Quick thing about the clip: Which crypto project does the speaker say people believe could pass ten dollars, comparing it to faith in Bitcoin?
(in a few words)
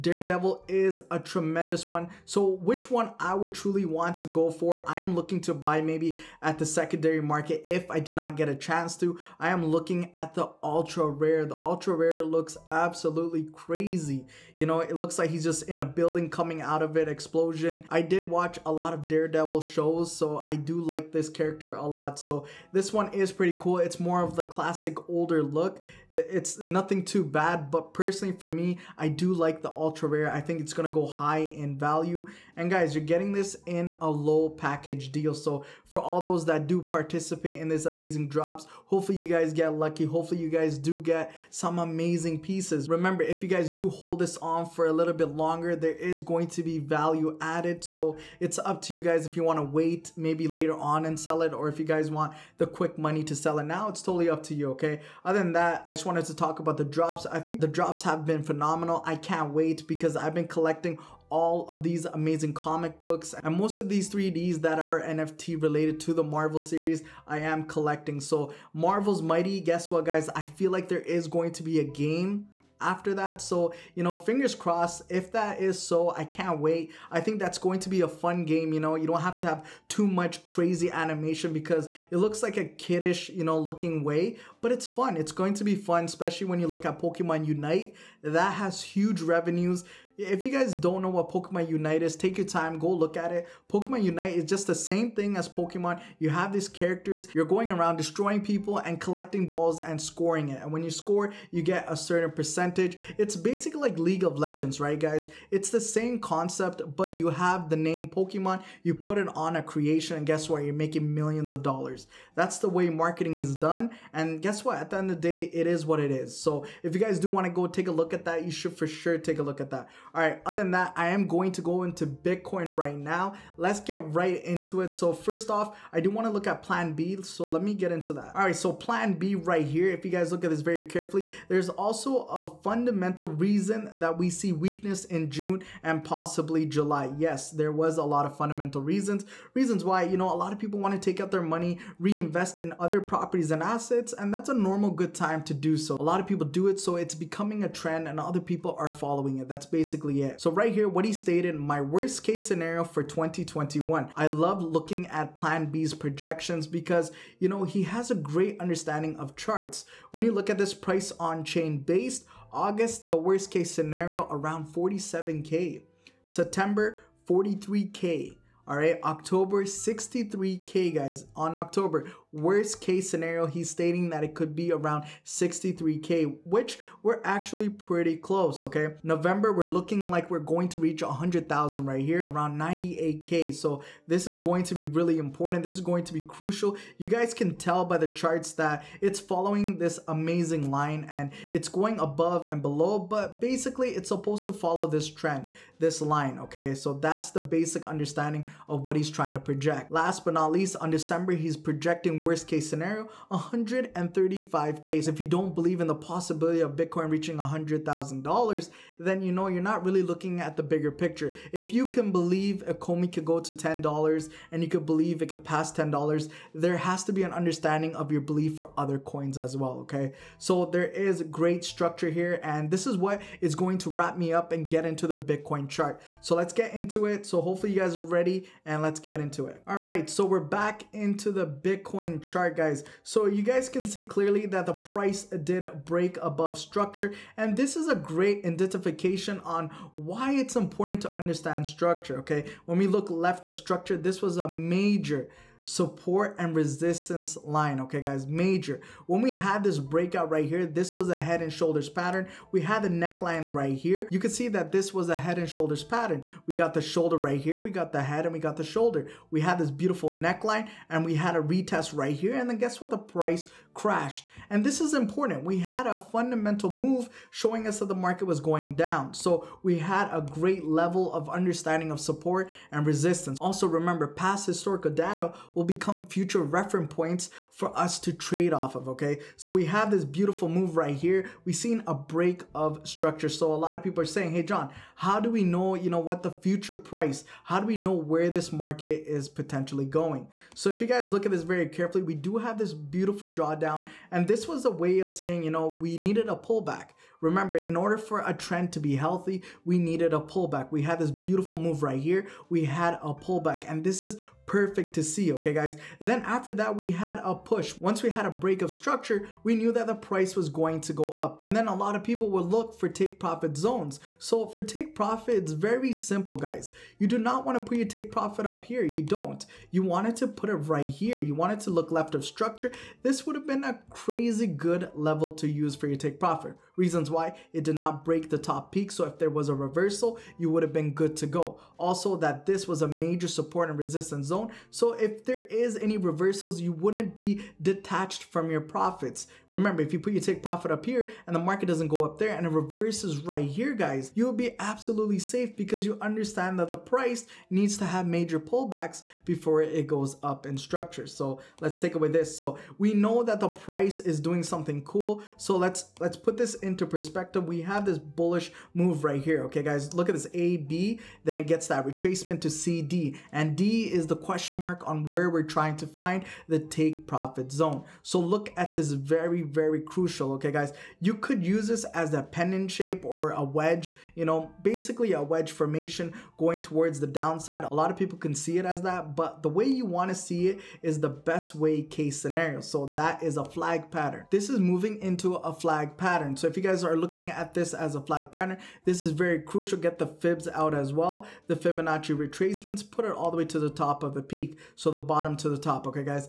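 Ecomi.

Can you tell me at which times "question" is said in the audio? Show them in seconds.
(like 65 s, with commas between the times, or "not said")
364 s.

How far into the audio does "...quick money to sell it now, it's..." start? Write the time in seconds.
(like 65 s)
52 s.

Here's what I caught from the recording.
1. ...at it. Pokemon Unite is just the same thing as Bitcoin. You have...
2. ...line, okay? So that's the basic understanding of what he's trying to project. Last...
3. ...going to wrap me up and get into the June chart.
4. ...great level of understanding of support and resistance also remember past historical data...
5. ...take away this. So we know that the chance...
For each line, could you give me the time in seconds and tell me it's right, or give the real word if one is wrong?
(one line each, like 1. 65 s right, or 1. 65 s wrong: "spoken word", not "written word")
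1. 93 s wrong: "Pokemon", not "Bitcoin"
2. 195 s right
3. 223 s wrong: "Bitcoin", not "June"
4. 270 s right
5. 351 s wrong: "price", not "chance".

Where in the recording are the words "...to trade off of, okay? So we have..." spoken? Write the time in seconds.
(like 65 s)
277 s.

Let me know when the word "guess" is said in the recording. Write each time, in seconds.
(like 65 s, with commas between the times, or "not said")
69 s, 110 s, 114 s, 262 s.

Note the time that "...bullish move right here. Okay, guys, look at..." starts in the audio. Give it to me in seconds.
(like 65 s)
357 s.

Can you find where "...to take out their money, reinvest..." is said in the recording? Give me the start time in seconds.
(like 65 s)
140 s.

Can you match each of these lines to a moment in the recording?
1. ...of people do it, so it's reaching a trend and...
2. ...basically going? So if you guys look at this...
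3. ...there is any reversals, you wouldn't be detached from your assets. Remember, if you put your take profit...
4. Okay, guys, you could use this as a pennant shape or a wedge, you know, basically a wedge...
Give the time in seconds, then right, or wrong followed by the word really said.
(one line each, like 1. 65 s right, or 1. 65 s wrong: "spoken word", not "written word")
1. 146 s wrong: "becoming", not "reaching"
2. 289 s wrong: "potentially", not "basically"
3. 335 s wrong: "profits", not "assets"
4. 370 s right.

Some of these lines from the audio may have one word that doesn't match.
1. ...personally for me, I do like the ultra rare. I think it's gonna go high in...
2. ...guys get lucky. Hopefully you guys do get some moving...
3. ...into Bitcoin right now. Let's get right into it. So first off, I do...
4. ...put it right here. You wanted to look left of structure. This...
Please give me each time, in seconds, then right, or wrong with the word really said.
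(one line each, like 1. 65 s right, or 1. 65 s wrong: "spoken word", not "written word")
1. 27 s right
2. 39 s wrong: "amazing", not "moving"
3. 121 s right
4. 320 s right.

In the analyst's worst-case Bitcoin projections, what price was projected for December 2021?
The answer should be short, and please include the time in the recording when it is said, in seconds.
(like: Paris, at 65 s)
135K, at 203 s.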